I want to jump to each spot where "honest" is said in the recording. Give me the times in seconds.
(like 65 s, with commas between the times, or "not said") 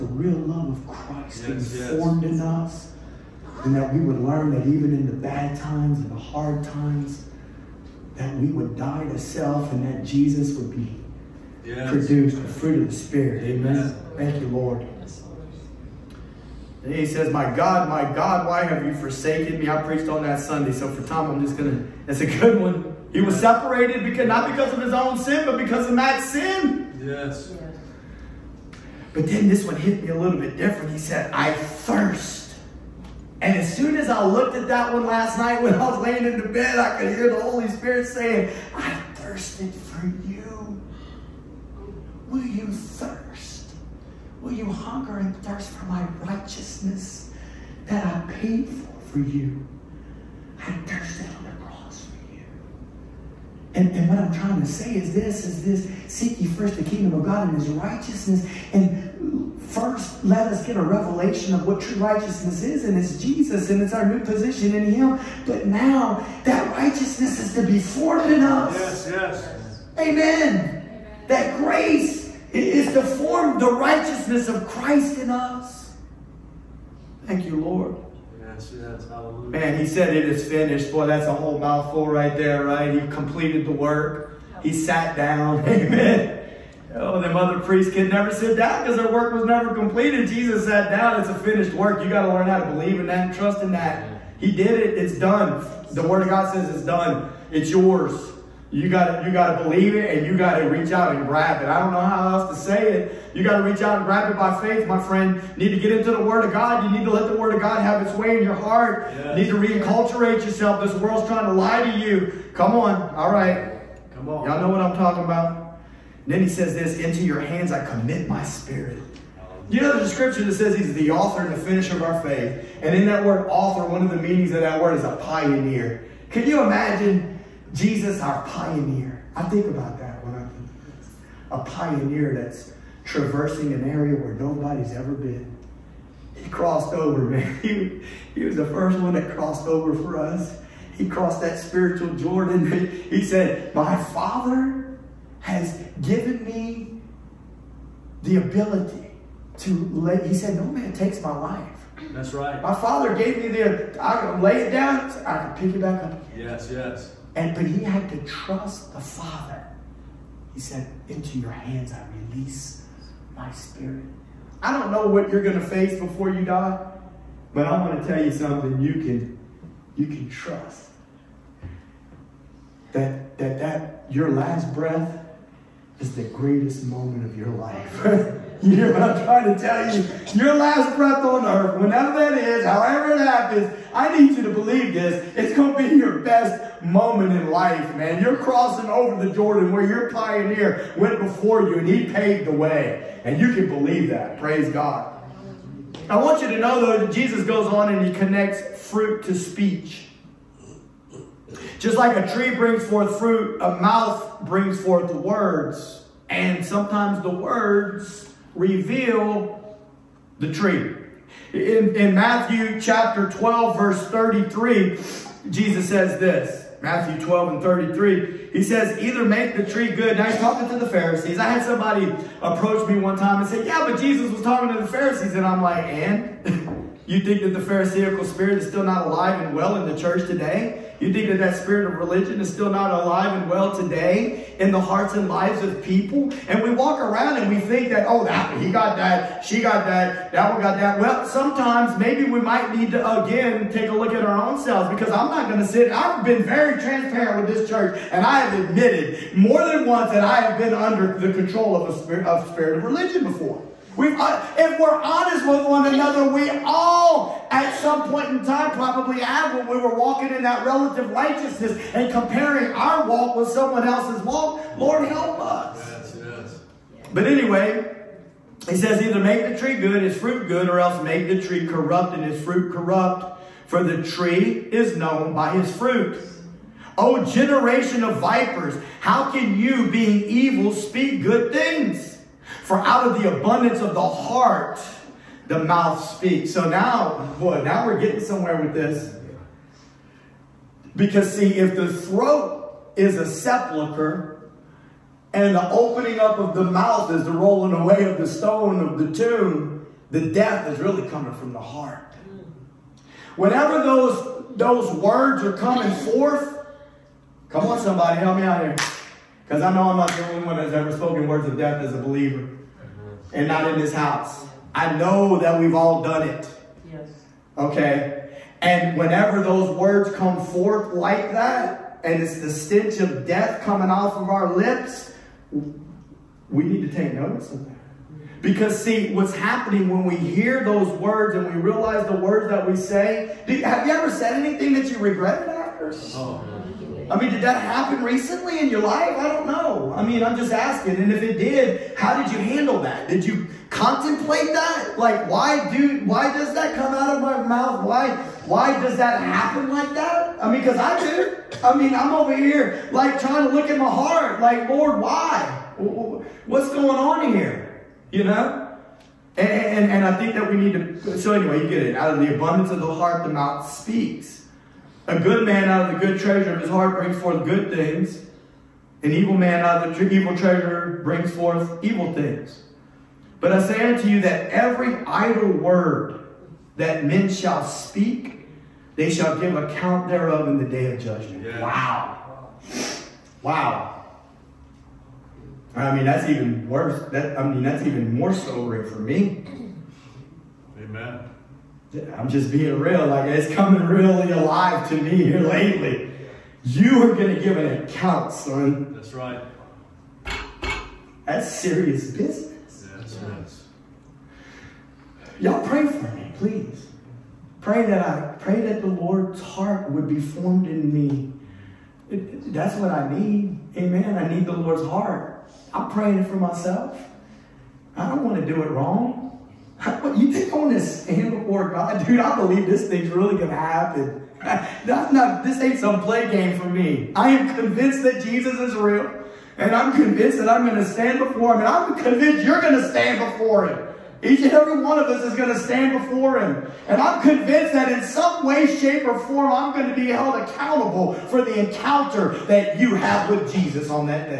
255 s.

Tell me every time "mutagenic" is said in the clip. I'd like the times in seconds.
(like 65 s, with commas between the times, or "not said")
not said.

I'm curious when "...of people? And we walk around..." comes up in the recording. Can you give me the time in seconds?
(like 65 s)
235 s.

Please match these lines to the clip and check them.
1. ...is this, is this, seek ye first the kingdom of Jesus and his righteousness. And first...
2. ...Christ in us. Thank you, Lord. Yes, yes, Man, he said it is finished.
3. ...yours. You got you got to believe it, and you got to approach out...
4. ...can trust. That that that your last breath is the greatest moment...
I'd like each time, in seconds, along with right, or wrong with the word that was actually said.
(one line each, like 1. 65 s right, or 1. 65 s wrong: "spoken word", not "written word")
1. 54 s wrong: "God", not "Jesus"
2. 74 s right
3. 97 s wrong: "reach", not "approach"
4. 170 s right.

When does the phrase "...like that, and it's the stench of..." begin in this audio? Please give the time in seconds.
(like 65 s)
320 s.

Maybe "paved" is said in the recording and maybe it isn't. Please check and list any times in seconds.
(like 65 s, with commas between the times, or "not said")
192 s.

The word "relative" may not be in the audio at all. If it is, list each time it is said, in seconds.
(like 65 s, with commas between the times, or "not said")
260 s.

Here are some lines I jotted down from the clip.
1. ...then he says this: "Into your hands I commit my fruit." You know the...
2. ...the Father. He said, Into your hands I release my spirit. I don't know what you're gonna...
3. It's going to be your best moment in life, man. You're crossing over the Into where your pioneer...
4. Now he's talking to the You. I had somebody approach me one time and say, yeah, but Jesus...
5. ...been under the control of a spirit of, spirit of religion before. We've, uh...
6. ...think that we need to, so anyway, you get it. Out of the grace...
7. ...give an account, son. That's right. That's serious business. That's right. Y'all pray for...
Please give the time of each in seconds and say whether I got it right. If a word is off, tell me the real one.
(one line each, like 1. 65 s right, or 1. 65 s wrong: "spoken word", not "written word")
1. 116 s wrong: "spirit", not "fruit"
2. 158 s right
3. 185 s wrong: "Jordan", not "Into"
4. 220 s wrong: "Pharisees", not "You"
5. 250 s right
6. 360 s wrong: "abundance", not "grace"
7. 397 s right.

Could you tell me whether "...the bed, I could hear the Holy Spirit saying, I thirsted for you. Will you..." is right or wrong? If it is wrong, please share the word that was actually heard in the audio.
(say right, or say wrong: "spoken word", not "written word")
right.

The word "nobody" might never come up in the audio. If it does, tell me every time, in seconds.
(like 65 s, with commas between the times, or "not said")
134 s.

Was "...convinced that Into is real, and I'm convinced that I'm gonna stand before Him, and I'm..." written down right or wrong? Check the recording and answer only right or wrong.
wrong.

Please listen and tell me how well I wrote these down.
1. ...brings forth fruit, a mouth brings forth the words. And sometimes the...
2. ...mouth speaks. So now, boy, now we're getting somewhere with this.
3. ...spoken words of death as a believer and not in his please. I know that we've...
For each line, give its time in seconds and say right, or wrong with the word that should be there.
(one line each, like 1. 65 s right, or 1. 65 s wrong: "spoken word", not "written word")
1. 202 s right
2. 285 s right
3. 310 s wrong: "house", not "please".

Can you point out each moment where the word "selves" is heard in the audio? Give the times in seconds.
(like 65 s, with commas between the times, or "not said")
244 s.